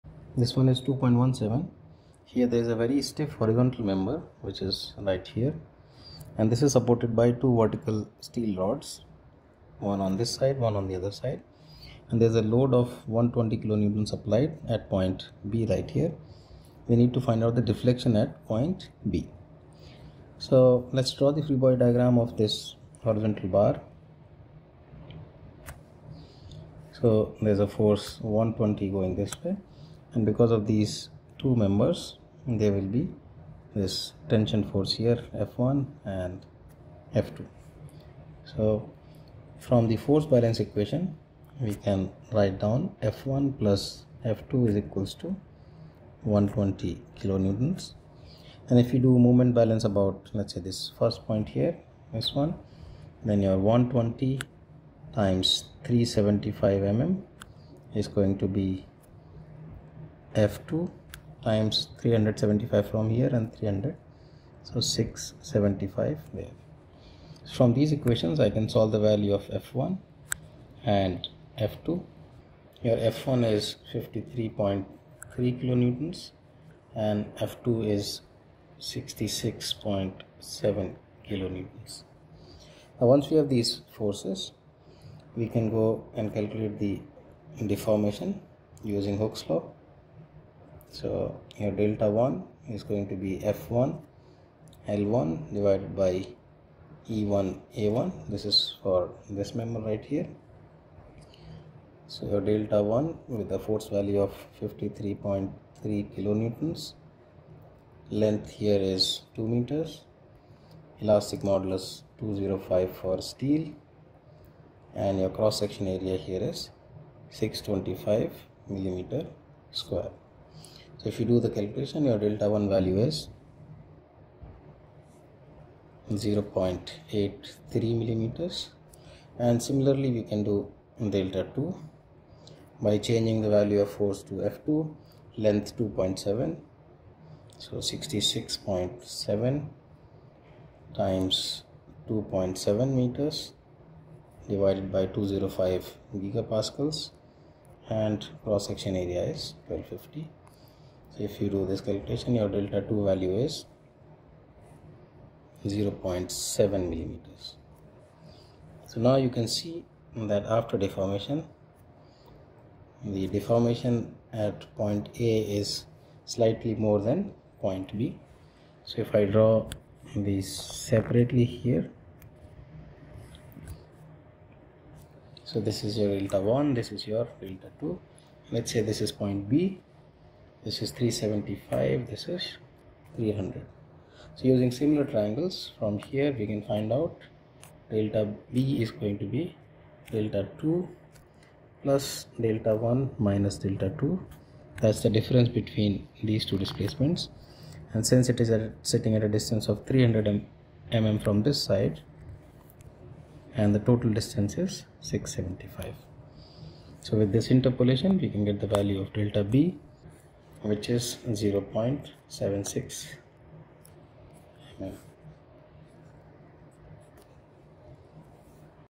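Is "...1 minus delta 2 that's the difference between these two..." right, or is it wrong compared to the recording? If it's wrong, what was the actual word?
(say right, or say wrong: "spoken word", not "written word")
right.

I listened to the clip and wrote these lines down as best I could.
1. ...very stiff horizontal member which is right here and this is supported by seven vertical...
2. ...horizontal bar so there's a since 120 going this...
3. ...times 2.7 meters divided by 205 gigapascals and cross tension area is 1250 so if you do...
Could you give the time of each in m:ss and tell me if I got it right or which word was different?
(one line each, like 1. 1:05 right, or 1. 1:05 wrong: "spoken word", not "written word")
1. 0:02 wrong: "two", not "seven"
2. 0:23 wrong: "force", not "since"
3. 2:20 wrong: "section", not "tension".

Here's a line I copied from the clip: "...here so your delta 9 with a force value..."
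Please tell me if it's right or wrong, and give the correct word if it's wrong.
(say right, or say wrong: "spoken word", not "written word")
wrong: "1", not "9".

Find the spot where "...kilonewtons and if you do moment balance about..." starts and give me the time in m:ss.
0:47.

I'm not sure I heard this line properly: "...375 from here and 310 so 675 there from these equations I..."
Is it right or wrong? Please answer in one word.
wrong.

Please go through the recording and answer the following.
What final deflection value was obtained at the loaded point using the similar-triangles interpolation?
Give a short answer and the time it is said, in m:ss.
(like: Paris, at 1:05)
0.76 mm, at 3:31.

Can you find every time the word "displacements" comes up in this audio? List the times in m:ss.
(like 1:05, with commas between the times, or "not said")
3:16.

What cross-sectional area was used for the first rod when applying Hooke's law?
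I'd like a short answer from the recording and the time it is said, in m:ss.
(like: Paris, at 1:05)
625 mm², at 1:57.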